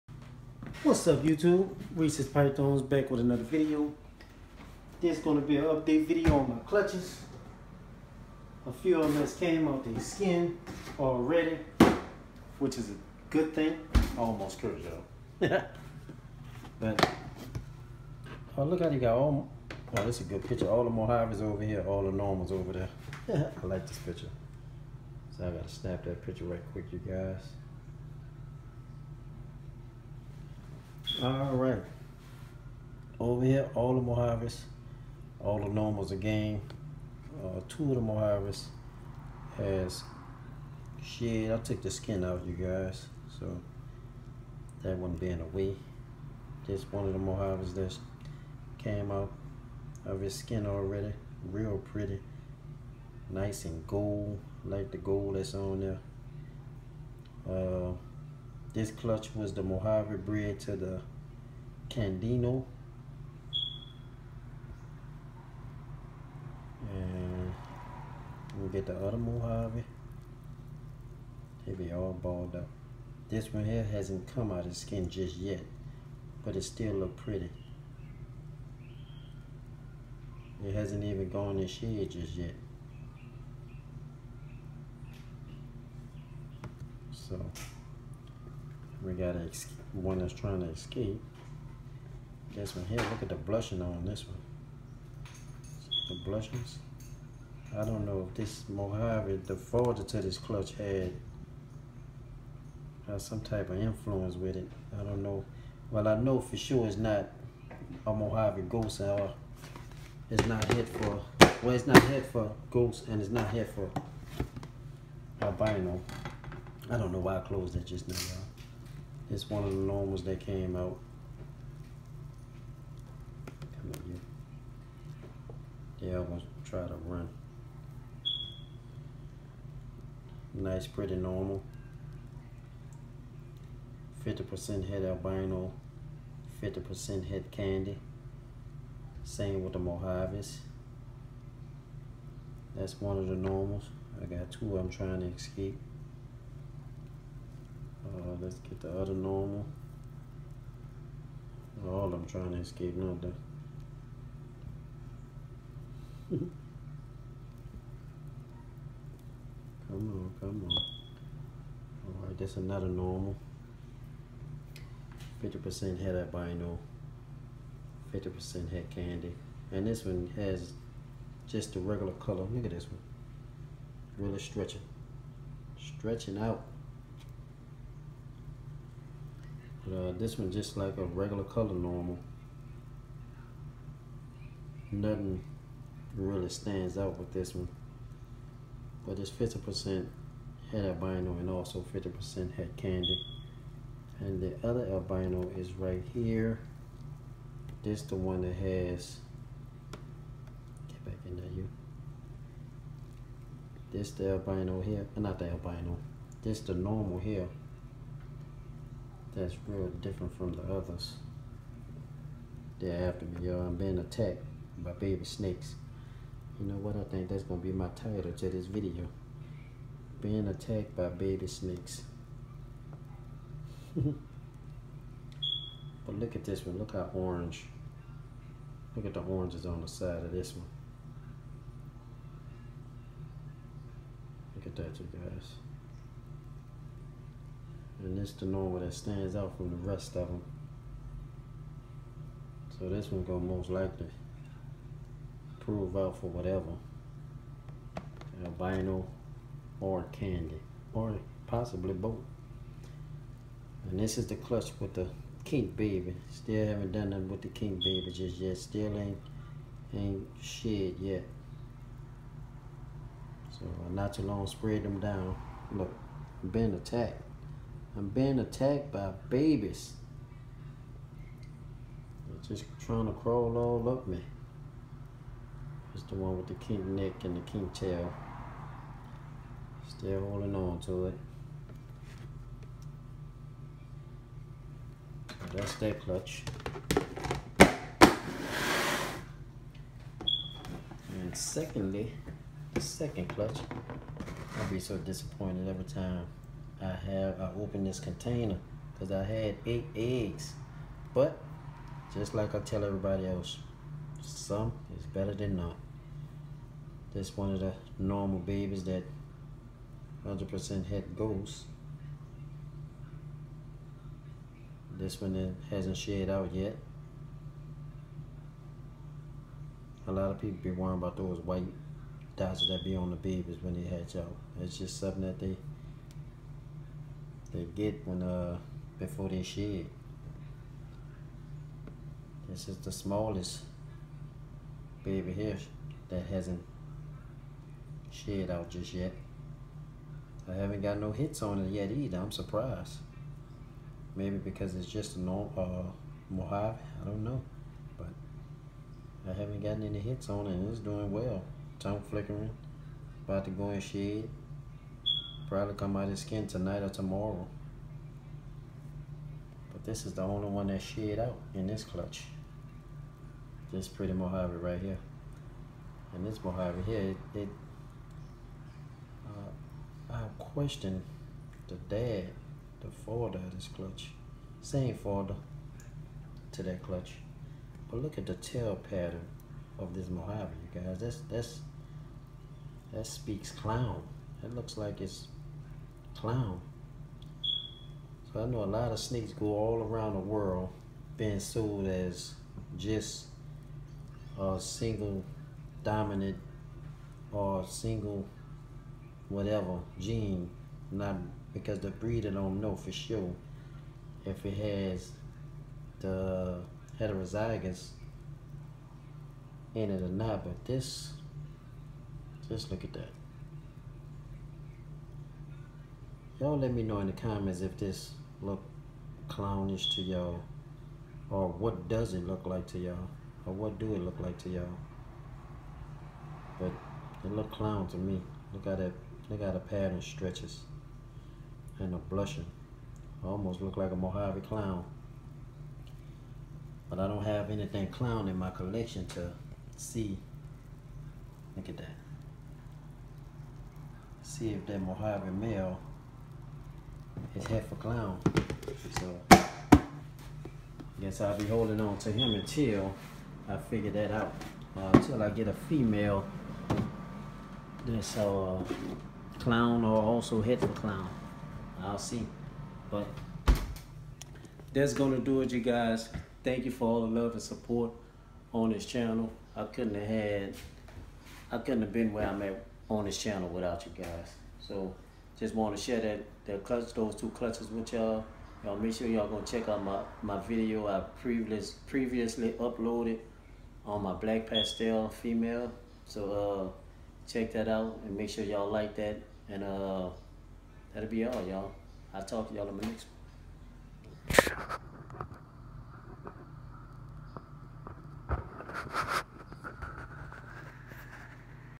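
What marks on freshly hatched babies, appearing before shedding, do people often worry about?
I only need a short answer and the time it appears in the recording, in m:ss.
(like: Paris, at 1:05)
white dots, at 5:21.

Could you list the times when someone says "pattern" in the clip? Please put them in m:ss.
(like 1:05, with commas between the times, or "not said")
6:18, 7:09.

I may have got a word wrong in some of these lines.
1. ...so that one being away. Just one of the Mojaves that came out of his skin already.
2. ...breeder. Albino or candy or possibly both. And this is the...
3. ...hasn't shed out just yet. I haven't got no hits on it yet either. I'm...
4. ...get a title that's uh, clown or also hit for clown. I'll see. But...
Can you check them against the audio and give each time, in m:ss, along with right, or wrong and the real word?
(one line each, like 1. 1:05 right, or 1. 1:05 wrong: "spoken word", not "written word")
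1. 0:43 right
2. 4:06 wrong: "whatever", not "breeder"
3. 5:36 right
4. 7:35 wrong: "female", not "title".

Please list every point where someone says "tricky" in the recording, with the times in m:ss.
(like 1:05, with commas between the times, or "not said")
not said.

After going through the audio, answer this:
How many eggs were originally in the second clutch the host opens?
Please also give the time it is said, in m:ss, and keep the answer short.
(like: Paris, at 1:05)
8, at 4:59.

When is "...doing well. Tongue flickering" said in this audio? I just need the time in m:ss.
5:50.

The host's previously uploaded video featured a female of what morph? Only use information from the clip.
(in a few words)
black pastel.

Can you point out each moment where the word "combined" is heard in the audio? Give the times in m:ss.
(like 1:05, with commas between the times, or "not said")
not said.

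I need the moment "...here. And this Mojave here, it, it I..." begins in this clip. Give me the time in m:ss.
6:04.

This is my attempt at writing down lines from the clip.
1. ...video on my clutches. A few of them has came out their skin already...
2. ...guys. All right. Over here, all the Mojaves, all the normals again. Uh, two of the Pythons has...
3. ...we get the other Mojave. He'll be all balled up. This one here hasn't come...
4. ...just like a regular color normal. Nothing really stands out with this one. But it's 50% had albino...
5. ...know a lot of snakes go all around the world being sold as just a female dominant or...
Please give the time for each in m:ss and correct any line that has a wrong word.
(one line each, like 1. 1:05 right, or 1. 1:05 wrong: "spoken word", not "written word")
1. 0:06 right
2. 0:27 wrong: "Mojaves", not "Pythons"
3. 1:08 right
4. 3:00 right
5. 6:28 wrong: "single", not "female".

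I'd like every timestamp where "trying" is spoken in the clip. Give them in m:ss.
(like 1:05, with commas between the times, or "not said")
1:30, 2:24, 2:32, 4:32.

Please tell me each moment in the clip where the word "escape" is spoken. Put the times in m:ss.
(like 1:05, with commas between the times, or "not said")
1:30, 2:25, 2:32.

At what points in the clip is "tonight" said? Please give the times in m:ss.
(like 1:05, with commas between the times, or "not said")
5:56.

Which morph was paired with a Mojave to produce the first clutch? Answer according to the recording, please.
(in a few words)
Candino.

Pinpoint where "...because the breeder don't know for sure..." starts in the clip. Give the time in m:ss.
6:41.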